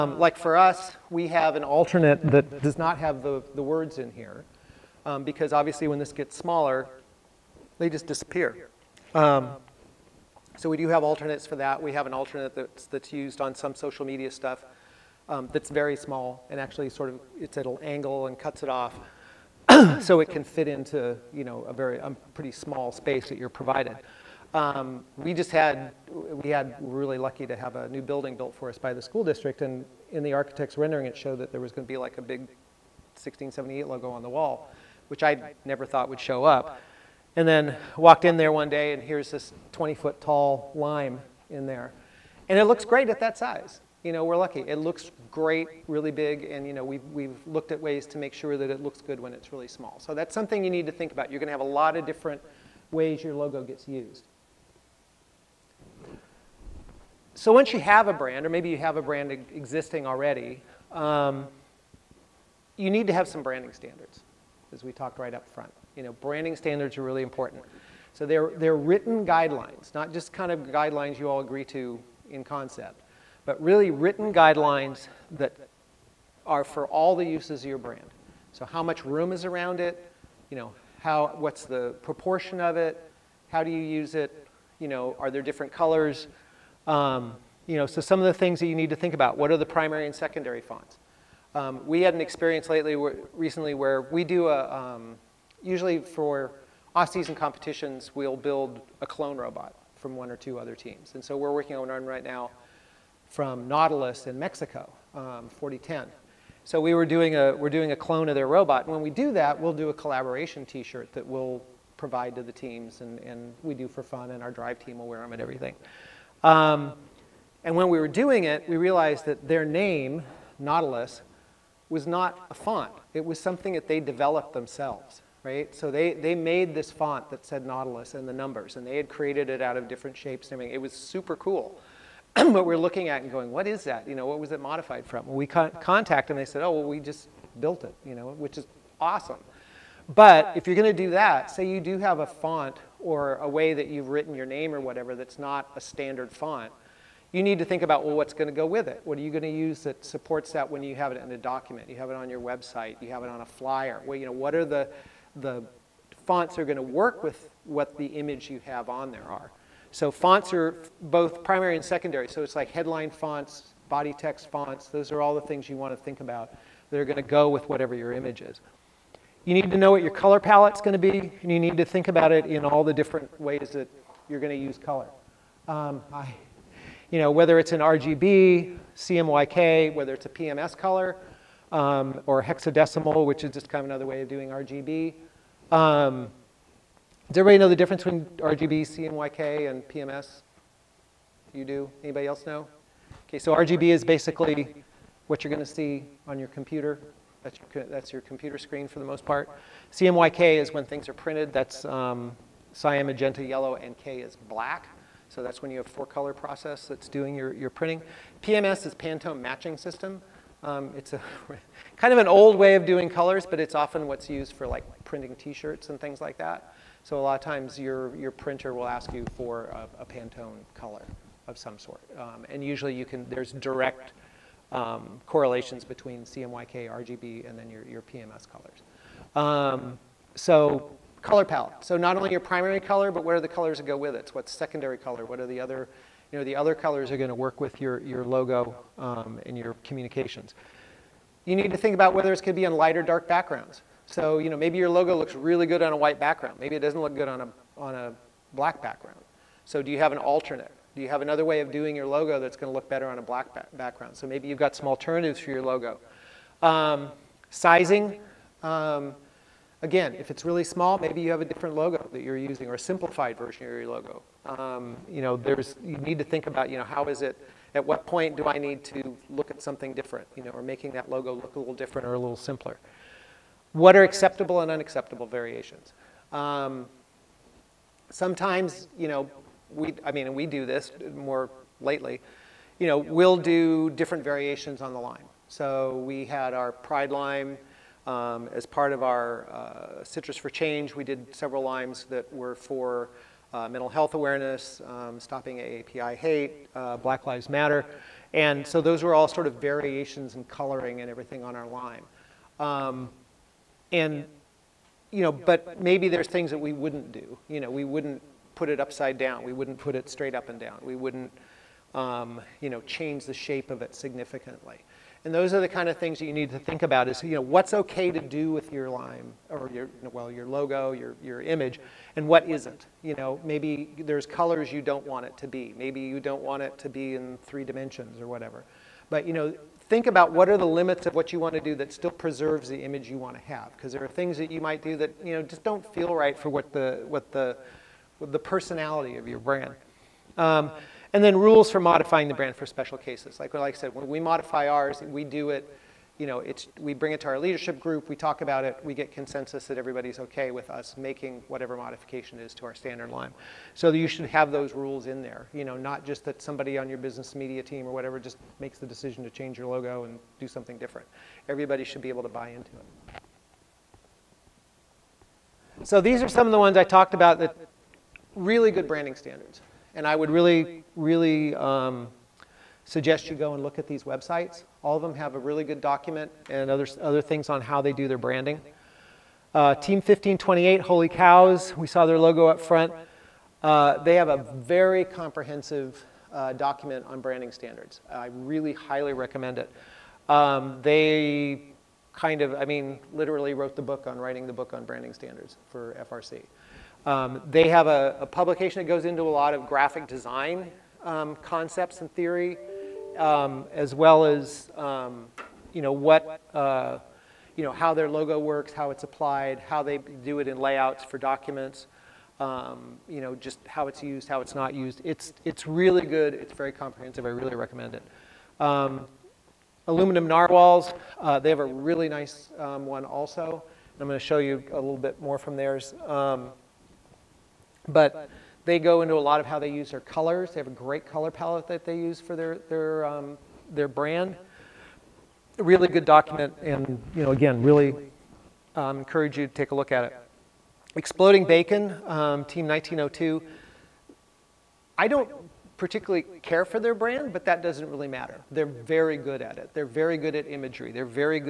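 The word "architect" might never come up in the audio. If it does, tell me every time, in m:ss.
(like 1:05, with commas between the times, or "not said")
0:30.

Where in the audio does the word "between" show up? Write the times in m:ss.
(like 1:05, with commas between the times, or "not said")
3:08, 3:45.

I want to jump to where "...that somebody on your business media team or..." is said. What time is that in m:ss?
5:56.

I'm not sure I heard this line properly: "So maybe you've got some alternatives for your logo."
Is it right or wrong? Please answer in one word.
right.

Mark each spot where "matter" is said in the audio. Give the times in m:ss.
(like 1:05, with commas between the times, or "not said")
4:57, 7:28.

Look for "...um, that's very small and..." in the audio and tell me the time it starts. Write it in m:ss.
0:15.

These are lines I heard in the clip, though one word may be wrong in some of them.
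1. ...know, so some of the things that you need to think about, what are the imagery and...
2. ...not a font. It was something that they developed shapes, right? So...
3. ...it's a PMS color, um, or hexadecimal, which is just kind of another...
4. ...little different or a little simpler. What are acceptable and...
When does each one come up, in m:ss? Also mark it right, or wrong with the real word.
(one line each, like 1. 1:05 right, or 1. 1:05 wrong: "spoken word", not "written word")
1. 1:27 wrong: "primary", not "imagery"
2. 2:02 wrong: "themselves", not "shapes"
3. 3:00 right
4. 4:31 right.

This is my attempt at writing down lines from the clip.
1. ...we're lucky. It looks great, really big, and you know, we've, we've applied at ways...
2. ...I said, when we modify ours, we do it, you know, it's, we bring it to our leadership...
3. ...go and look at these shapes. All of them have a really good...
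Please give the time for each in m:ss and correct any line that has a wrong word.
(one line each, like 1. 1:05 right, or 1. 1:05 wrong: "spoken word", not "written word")
1. 0:44 wrong: "looked", not "applied"
2. 5:43 right
3. 6:13 wrong: "websites", not "shapes".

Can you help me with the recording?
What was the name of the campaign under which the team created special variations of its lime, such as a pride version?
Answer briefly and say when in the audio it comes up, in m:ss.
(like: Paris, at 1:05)
Citrus for Change, at 4:50.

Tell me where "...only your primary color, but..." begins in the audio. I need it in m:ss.
3:52.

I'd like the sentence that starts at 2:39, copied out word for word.
So fonts are both primary and secondary.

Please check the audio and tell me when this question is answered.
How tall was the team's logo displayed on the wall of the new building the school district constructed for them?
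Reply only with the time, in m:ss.
0:39.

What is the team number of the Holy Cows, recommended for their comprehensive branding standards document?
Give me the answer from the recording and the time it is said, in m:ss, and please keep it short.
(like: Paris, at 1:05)
1528, at 6:19.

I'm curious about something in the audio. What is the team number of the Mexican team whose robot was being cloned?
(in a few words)
4010.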